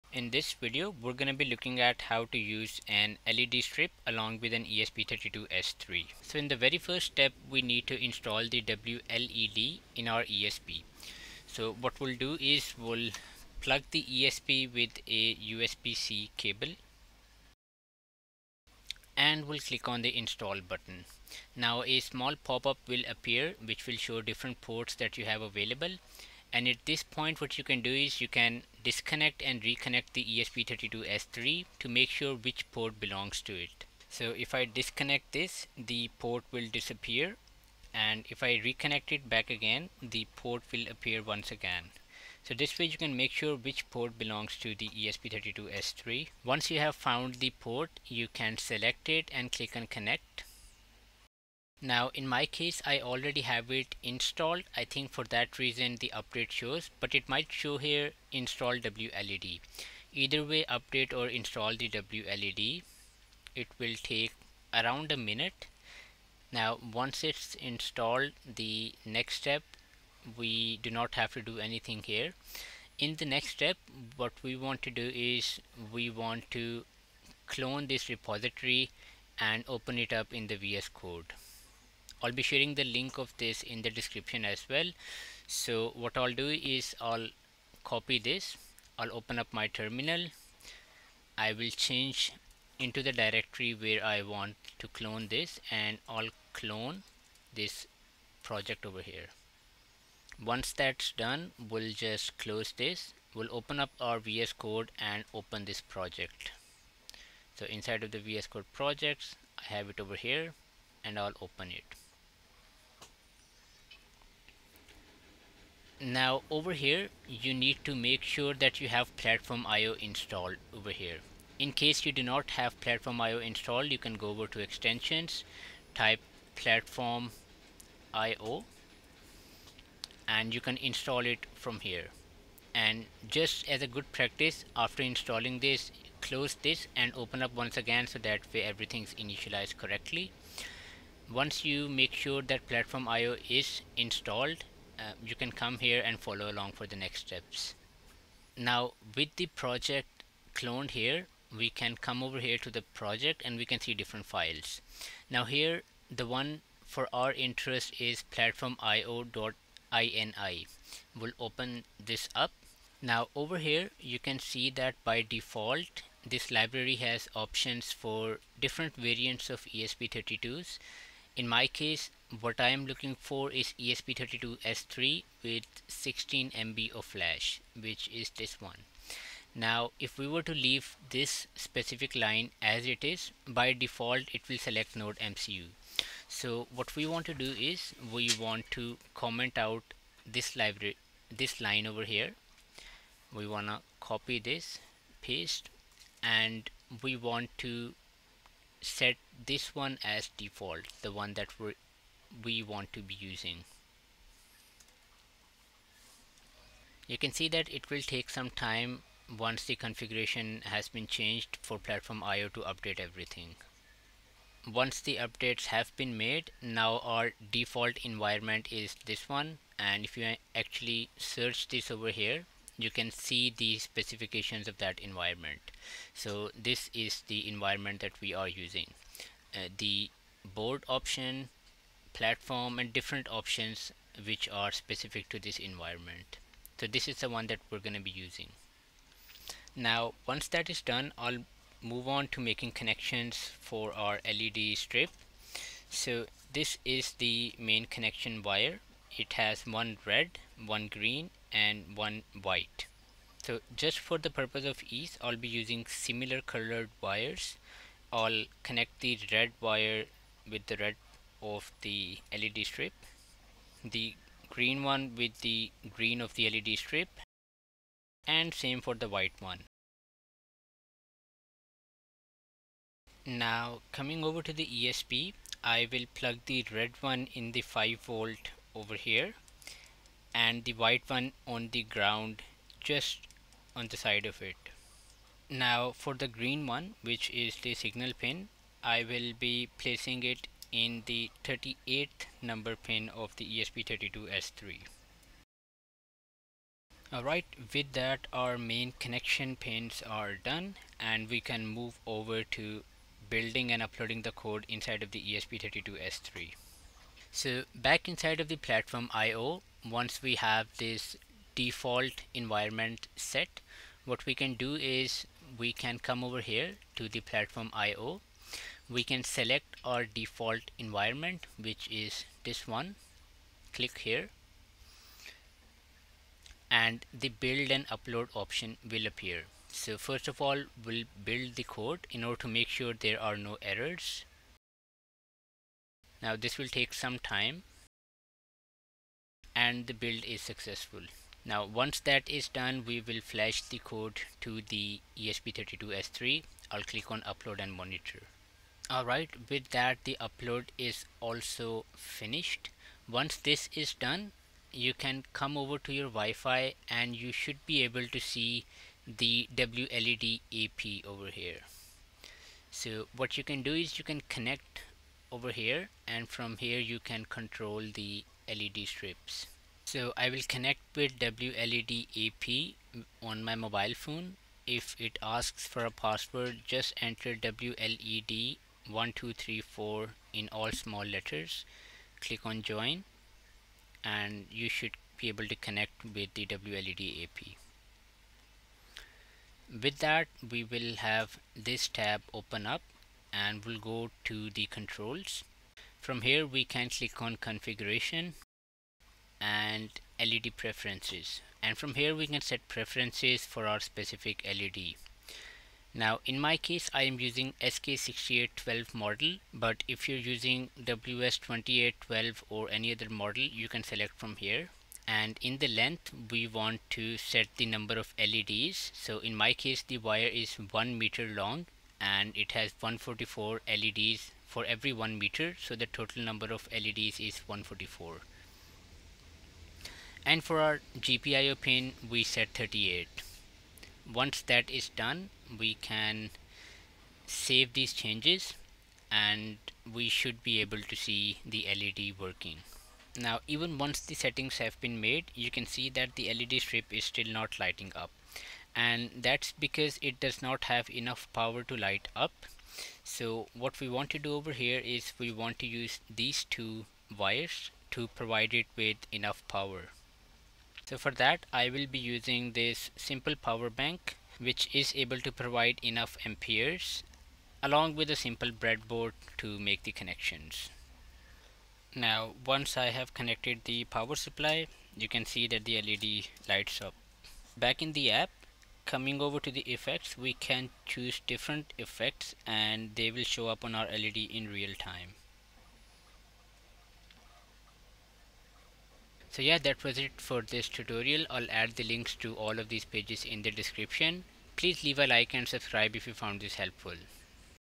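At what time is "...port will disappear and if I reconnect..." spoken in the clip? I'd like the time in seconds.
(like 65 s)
36 s.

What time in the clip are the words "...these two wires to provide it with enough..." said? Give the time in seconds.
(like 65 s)
456 s.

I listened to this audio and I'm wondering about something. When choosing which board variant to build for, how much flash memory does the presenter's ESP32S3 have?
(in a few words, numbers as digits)
16 MB.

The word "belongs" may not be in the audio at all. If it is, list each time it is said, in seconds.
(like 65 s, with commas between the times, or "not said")
32 s, 44 s.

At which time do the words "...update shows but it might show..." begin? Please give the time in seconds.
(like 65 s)
56 s.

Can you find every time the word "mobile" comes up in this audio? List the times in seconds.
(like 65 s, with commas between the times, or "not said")
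373 s.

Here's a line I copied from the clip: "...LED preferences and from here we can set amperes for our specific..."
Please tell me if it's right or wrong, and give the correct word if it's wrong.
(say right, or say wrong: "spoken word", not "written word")
wrong: "preferences", not "amperes".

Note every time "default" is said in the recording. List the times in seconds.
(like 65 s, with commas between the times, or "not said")
165 s, 183 s, 200 s, 217 s, 311 s, 320 s.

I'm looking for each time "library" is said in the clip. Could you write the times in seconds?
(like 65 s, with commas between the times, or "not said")
166 s, 190 s.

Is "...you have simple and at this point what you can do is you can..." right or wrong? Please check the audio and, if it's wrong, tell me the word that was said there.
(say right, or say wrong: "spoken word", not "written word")
wrong: "available", not "simple".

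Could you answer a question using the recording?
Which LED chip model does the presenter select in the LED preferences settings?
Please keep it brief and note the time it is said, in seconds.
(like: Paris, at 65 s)
SK6812, at 407 s.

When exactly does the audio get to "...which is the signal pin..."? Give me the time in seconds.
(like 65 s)
287 s.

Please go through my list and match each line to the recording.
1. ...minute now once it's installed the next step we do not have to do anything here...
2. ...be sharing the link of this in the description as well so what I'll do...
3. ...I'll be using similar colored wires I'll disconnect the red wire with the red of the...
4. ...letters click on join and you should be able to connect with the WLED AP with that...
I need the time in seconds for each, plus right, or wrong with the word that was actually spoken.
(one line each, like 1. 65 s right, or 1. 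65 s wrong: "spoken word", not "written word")
1. 65 s right
2. 82 s right
3. 255 s wrong: "connect", not "disconnect"
4. 381 s right.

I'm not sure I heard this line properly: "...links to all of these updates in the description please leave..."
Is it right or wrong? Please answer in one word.
wrong.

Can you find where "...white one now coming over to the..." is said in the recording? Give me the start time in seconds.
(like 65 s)
269 s.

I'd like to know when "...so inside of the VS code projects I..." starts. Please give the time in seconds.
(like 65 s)
107 s.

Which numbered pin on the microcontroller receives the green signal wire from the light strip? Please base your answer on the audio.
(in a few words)
38.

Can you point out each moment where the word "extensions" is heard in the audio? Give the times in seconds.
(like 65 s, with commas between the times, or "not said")
124 s.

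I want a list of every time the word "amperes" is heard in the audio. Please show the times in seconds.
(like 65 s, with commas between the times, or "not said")
466 s.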